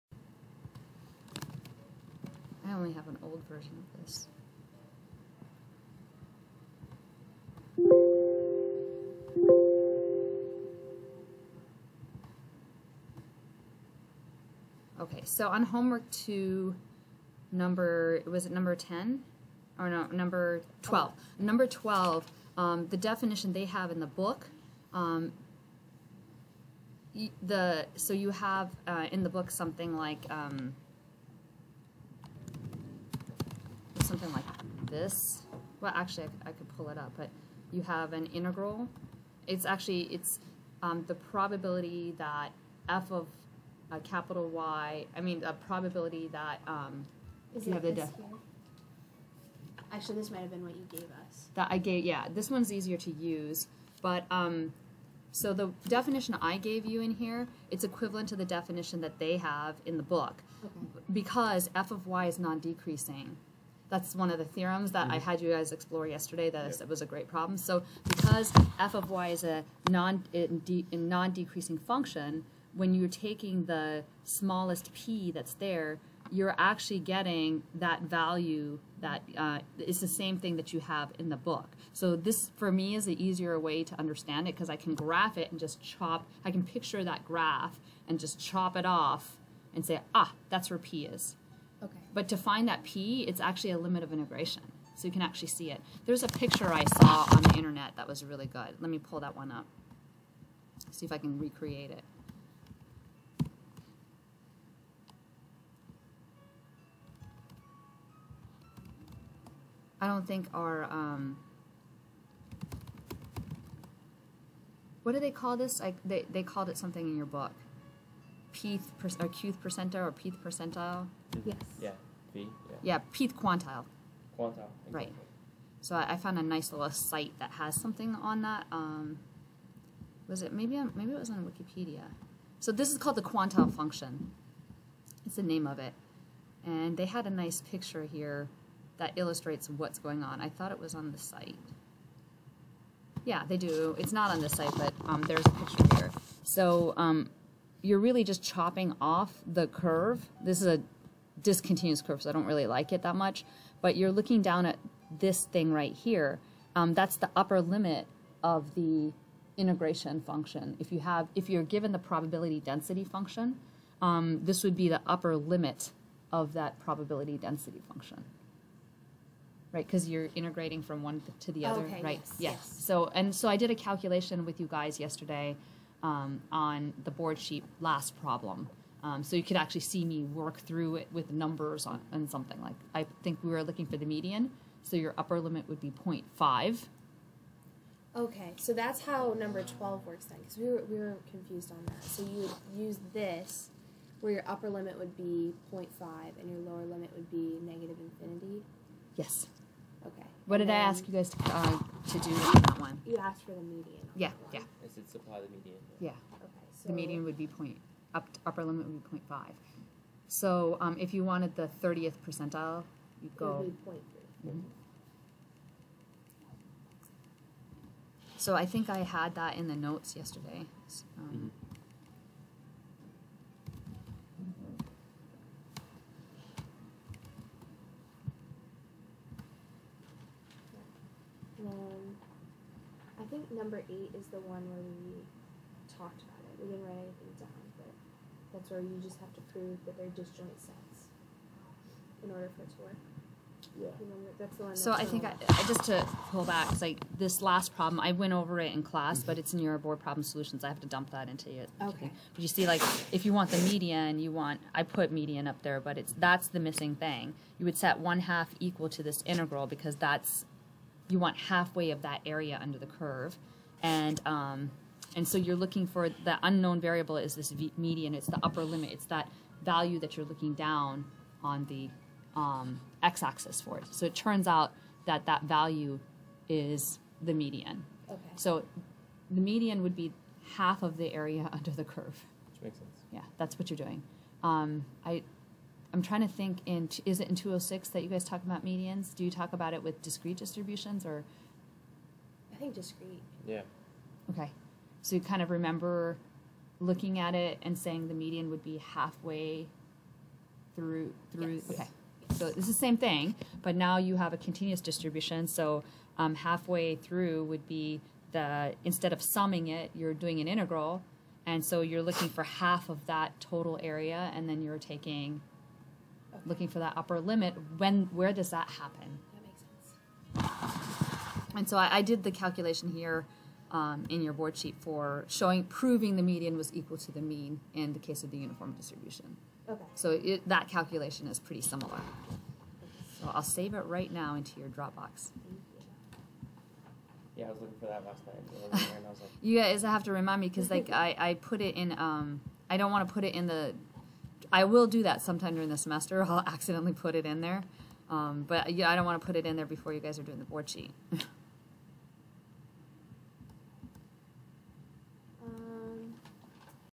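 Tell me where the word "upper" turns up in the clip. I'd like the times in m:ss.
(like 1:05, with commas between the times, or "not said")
2:37, 2:45, 3:05, 3:14, 3:28, 4:28, 5:16.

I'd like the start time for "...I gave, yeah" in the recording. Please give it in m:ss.
0:51.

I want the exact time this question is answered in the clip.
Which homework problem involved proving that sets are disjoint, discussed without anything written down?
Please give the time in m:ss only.
3:53.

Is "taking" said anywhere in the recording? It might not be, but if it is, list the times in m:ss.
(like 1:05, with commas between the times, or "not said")
1:13, 5:14.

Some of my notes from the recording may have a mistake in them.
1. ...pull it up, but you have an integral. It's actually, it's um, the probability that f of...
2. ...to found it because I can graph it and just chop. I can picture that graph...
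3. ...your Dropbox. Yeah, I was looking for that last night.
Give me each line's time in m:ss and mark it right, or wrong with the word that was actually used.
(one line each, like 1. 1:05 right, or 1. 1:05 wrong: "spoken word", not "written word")
1. 0:36 right
2. 1:23 wrong: "understand", not "found"
3. 5:34 right.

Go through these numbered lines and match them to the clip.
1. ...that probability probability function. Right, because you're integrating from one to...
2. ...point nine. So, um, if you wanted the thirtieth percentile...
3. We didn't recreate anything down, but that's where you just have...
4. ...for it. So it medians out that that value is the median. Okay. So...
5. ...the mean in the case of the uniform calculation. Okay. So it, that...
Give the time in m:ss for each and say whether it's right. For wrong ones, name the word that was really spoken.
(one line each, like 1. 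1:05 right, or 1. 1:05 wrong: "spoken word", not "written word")
1. 2:46 wrong: "density", not "probability"
2. 3:29 wrong: "five", not "nine"
3. 3:56 wrong: "write", not "recreate"
4. 4:33 wrong: "turns", not "medians"
5. 5:27 wrong: "distribution", not "calculation".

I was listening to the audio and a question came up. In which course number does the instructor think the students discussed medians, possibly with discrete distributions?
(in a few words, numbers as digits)
206.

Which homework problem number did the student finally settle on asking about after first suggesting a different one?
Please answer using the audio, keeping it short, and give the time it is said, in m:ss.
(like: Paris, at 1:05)
12, at 0:19.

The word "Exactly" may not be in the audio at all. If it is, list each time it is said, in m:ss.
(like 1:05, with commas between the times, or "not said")
2:04.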